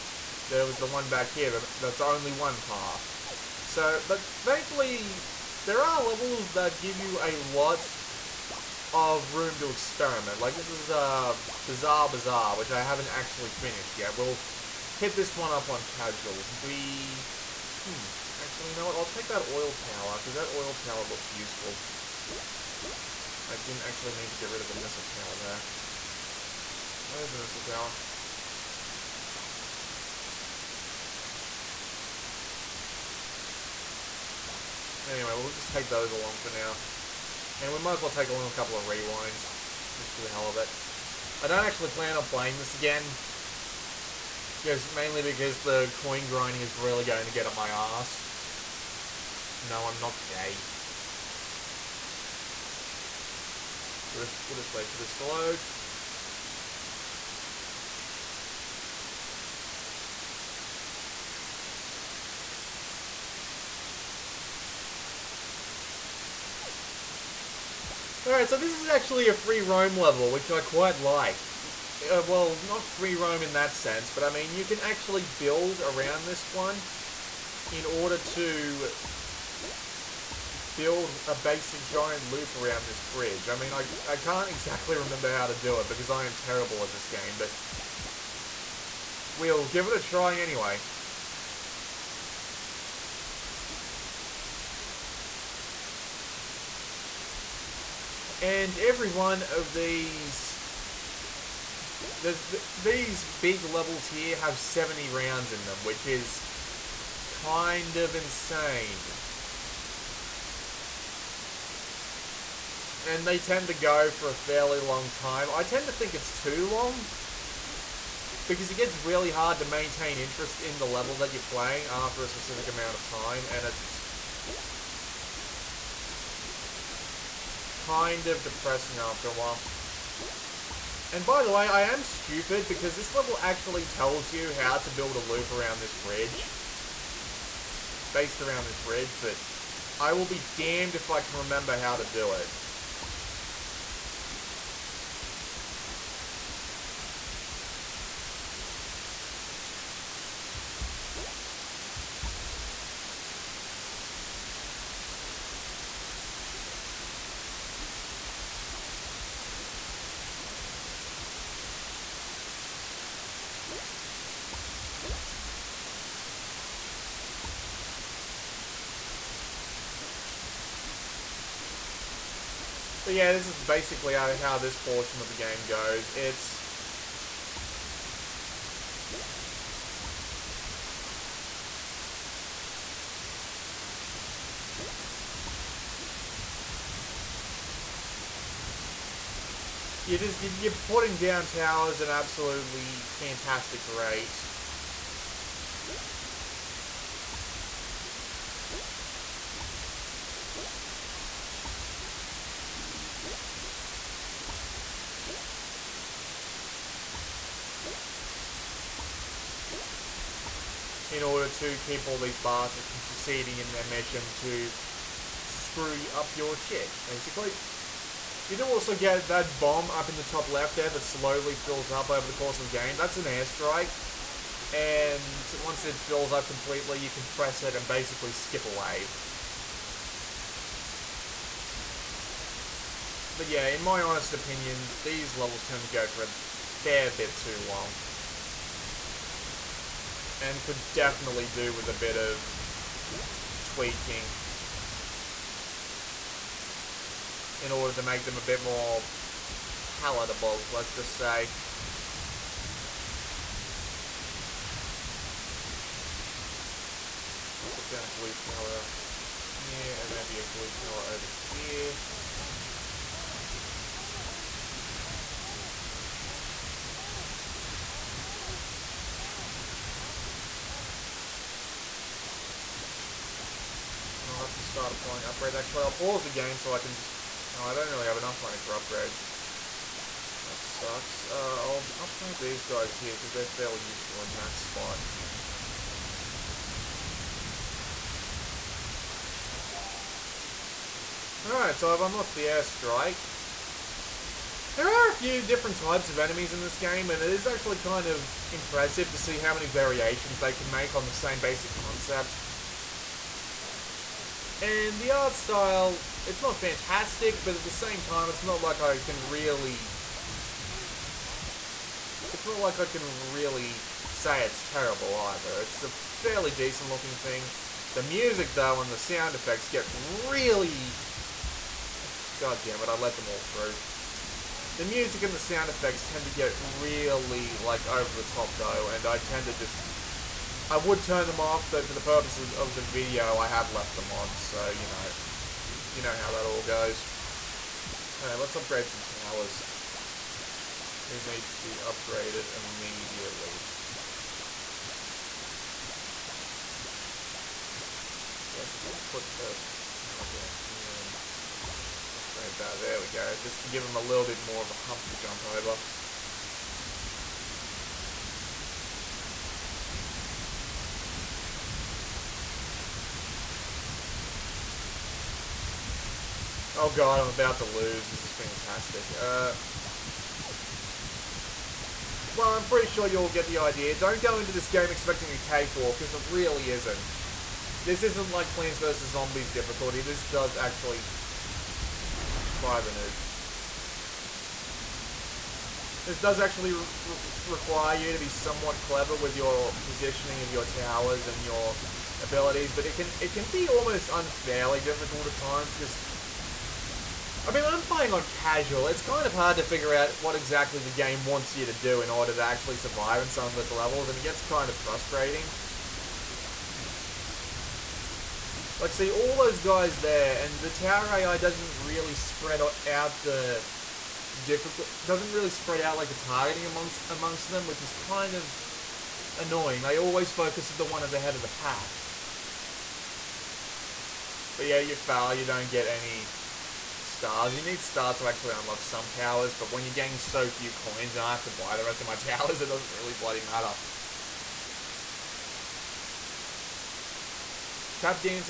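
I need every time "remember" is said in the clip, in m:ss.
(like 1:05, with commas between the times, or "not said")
1:24, 2:21.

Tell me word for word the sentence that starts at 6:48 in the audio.
Like, see, all those guys there, and the tower AI doesn't really spread out the difficult...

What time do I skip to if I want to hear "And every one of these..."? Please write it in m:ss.
1:38.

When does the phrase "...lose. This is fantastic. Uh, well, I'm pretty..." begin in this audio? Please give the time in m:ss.
6:07.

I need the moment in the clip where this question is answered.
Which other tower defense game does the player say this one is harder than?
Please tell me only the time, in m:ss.
6:18.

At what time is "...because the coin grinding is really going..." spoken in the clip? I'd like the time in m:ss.
0:45.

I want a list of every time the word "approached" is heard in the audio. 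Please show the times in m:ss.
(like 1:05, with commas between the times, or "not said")
not said.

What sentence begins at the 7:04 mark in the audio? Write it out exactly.
But yeah, you foul, you don't get any stars.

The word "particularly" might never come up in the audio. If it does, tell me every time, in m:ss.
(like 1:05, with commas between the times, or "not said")
not said.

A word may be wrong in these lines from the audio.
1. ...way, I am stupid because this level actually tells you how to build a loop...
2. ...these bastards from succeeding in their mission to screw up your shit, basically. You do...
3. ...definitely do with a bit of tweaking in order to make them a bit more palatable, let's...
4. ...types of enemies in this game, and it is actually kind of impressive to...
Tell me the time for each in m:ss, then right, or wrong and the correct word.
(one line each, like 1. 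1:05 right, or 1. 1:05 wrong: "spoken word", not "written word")
1. 2:11 right
2. 3:32 right
3. 4:00 right
4. 4:55 right.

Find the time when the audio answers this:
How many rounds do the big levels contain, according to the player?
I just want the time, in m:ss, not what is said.
1:44.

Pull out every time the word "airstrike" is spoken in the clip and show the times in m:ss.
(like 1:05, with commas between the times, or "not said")
3:43, 4:52.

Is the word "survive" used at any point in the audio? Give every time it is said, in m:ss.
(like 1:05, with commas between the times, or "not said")
6:42.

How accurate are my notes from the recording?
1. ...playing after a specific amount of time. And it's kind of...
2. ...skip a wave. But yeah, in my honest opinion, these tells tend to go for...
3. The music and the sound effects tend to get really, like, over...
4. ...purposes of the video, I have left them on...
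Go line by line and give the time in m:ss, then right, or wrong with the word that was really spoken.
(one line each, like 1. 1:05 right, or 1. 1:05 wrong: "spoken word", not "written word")
1. 2:01 right
2. 3:48 wrong: "levels", not "tells"
3. 5:24 right
4. 5:32 right.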